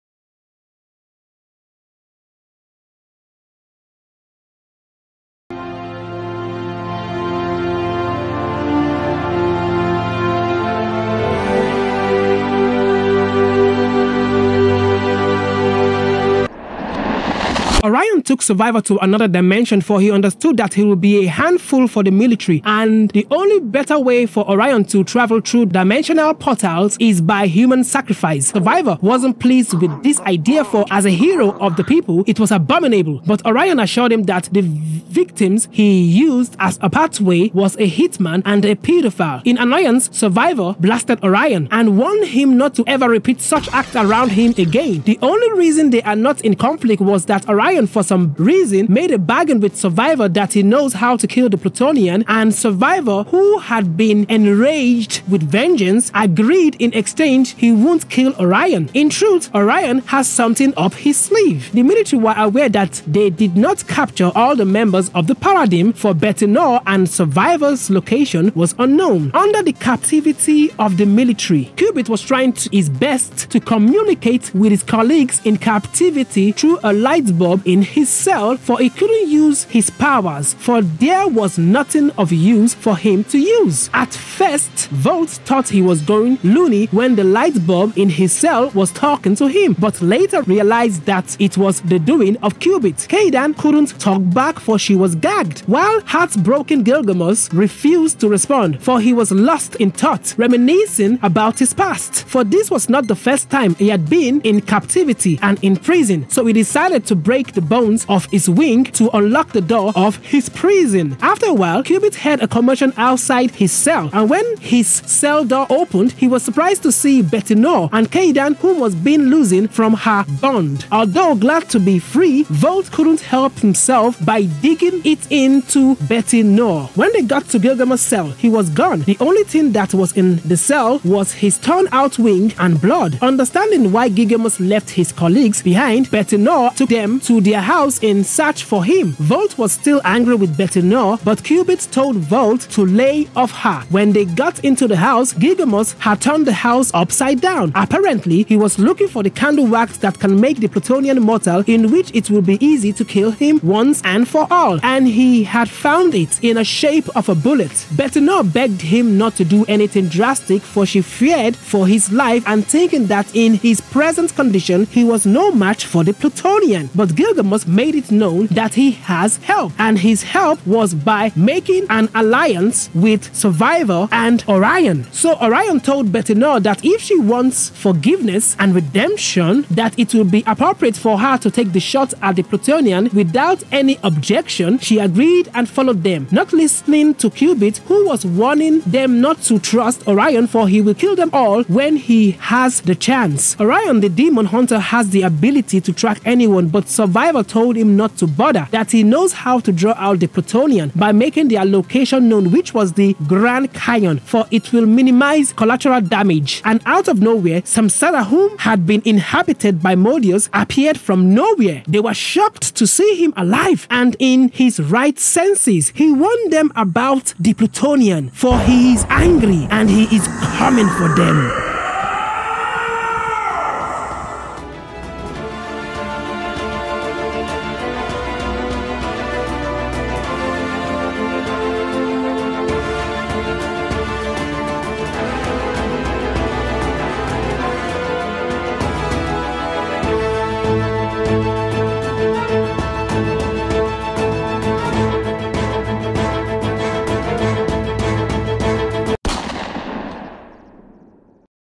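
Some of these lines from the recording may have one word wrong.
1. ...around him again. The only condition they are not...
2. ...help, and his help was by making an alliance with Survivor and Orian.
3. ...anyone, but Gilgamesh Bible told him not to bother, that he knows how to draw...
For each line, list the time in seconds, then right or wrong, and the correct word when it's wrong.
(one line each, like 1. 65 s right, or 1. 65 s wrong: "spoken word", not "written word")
1. 43 s wrong: "reason", not "condition"
2. 169 s right
3. 196 s wrong: "Survivor", not "Gilgamesh".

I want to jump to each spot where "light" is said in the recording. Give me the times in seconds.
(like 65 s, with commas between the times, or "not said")
76 s, 87 s.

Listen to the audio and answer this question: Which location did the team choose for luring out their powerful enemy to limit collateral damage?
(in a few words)
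The Grand Canyon.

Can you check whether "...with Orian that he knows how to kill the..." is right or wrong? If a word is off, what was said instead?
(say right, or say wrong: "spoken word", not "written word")
wrong: "Survivor", not "Orian".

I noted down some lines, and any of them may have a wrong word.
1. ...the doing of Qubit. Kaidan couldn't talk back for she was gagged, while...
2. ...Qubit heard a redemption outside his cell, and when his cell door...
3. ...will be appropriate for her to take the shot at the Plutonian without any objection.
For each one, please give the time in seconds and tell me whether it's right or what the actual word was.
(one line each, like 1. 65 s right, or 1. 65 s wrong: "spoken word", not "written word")
1. 91 s right
2. 111 s wrong: "commotion", not "redemption"
3. 180 s right.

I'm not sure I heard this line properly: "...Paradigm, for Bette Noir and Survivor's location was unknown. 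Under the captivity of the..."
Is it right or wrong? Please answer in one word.
right.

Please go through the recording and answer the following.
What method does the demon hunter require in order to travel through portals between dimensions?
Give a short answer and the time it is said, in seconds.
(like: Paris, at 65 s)
Human sacrifice, at 27 s.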